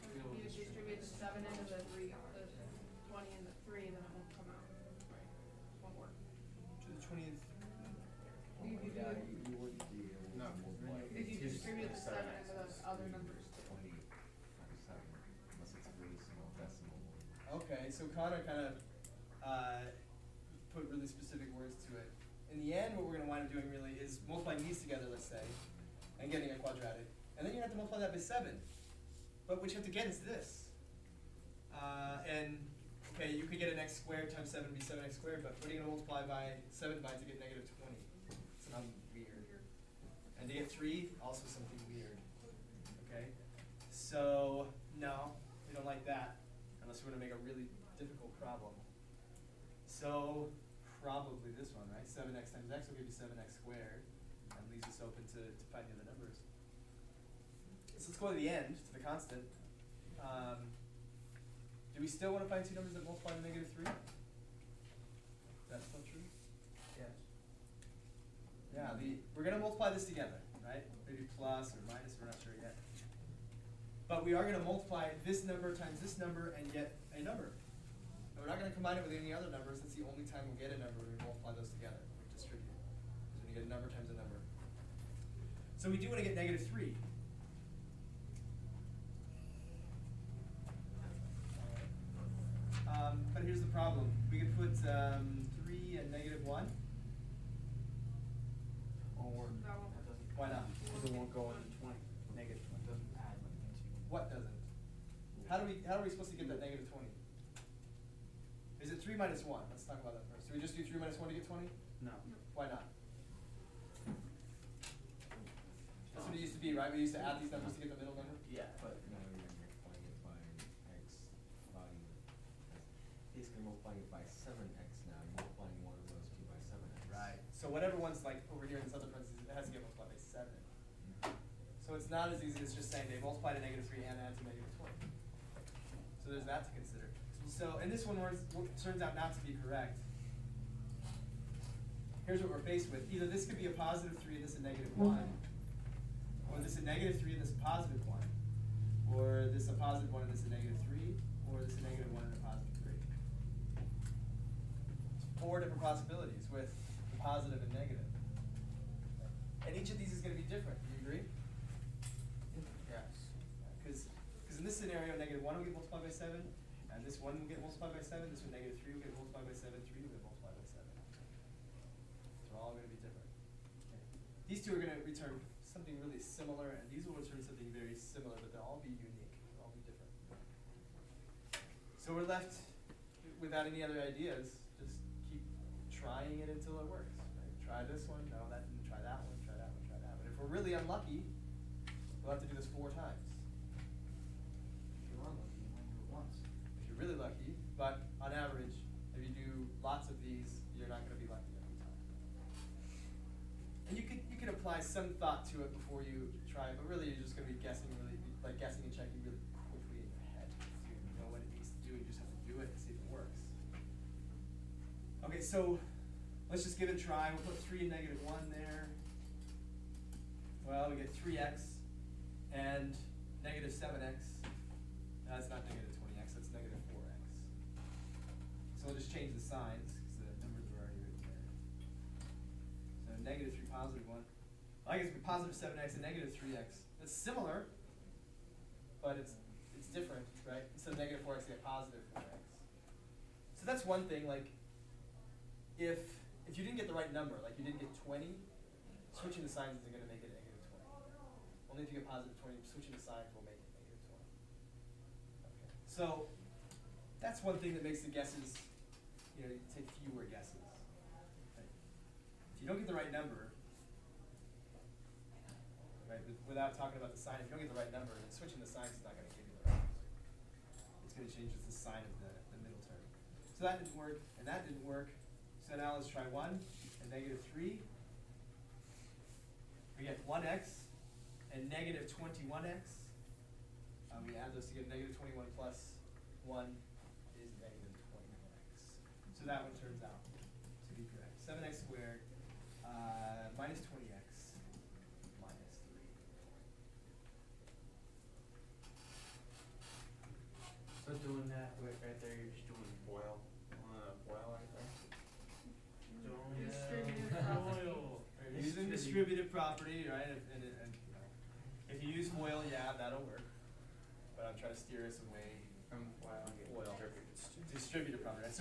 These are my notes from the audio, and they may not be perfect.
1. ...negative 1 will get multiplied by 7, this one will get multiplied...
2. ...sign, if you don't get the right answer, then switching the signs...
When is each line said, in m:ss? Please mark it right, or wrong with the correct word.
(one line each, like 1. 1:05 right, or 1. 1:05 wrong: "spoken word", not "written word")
1. 2:45 right
2. 4:27 wrong: "number", not "answer".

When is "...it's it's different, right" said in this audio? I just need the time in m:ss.
3:59.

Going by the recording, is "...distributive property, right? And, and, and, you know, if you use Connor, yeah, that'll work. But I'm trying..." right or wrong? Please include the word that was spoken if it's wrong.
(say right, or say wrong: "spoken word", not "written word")
wrong: "FOIL", not "Connor".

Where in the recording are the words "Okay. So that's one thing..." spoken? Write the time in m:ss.
4:15.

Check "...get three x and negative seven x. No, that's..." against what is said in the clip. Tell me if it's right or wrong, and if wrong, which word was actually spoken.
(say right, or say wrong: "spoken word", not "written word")
right.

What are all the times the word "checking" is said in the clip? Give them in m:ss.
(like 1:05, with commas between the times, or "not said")
3:28.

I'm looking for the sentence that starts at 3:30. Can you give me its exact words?
So you know what it needs to do, and you just have to do it and see if it works.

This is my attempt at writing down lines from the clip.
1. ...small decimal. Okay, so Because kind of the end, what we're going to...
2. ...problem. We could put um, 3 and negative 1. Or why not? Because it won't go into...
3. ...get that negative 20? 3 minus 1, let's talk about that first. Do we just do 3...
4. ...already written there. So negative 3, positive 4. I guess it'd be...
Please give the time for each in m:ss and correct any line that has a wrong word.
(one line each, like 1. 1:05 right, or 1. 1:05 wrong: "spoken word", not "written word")
1. 0:16 wrong: "Connor", not "Because"
2. 1:33 right
3. 1:46 right
4. 3:50 wrong: "1", not "4".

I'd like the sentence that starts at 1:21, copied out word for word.
We distribute Because when you get a number times a number.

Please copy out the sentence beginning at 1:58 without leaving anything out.
Yeah, but now we are multiplying it by x value.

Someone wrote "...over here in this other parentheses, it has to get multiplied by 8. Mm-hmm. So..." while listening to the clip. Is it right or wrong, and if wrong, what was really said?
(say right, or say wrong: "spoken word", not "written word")
wrong: "7", not "8".